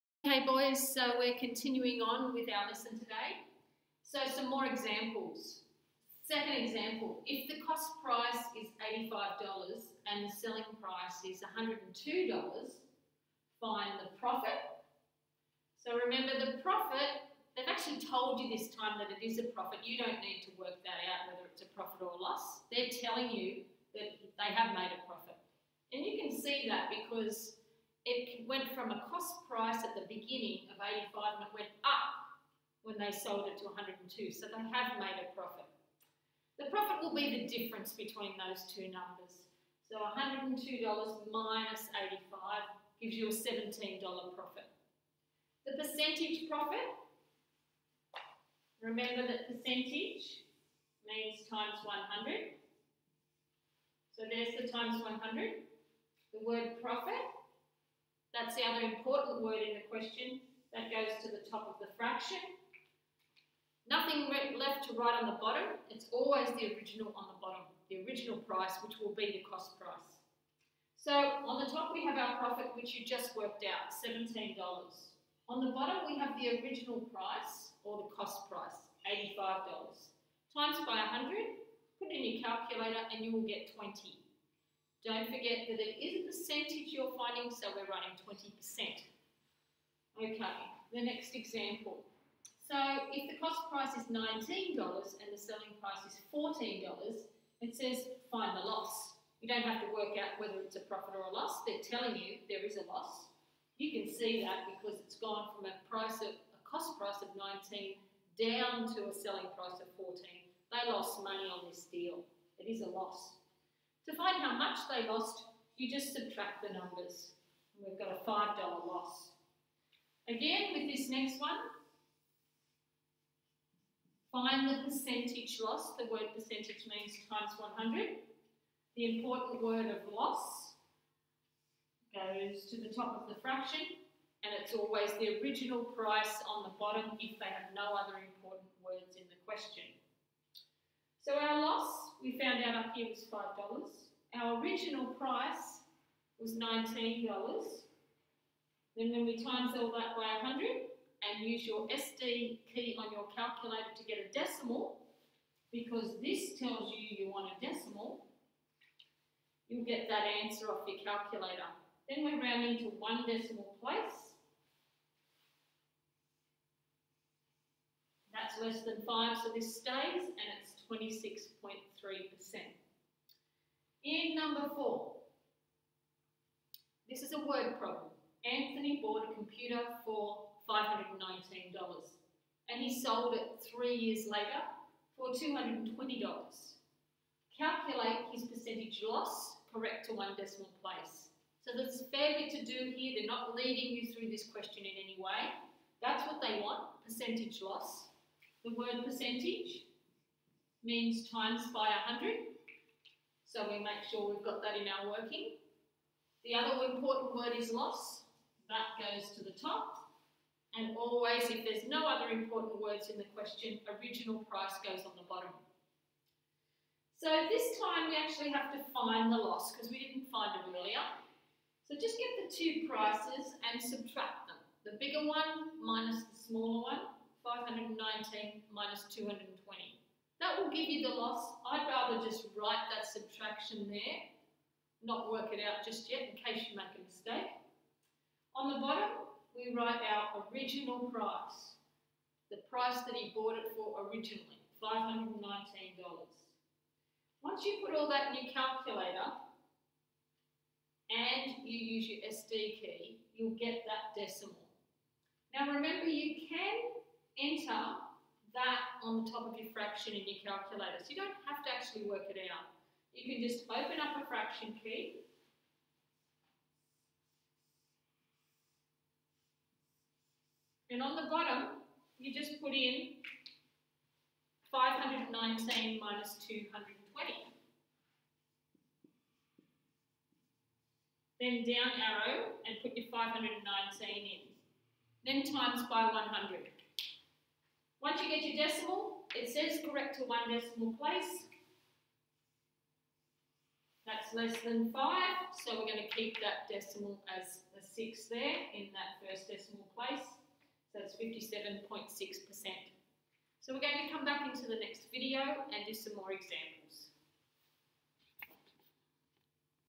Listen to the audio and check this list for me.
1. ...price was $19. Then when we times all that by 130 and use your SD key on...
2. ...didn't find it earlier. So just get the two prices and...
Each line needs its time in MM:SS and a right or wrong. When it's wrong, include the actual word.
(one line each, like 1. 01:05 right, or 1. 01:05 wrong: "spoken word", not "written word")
1. 02:25 wrong: "100", not "130"
2. 03:40 right.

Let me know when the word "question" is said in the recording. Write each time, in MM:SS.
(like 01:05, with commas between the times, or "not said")
00:59, 02:19, 03:14, 03:33.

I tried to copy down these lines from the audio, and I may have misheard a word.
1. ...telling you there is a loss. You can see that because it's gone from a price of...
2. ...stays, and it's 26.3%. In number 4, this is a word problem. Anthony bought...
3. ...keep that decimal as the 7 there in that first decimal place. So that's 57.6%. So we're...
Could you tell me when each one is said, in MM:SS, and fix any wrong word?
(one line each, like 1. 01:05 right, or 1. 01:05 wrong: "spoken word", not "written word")
1. 01:41 right
2. 02:49 right
3. 04:56 wrong: "6", not "7".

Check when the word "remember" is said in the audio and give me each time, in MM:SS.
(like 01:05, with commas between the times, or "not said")
00:16, 00:48, 04:15.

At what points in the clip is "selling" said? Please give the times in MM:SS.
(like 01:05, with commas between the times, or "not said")
00:10, 01:35, 01:49.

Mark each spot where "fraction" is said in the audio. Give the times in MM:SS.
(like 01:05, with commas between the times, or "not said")
01:01, 02:13, 04:19, 04:24.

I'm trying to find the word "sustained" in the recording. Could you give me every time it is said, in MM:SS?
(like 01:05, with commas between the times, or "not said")
not said.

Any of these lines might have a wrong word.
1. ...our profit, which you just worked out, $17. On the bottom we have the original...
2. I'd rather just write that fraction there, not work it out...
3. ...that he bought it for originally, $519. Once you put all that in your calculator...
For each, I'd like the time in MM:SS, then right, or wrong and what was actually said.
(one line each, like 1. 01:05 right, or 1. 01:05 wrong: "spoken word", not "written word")
1. 01:12 right
2. 03:51 wrong: "subtraction", not "fraction"
3. 04:03 right.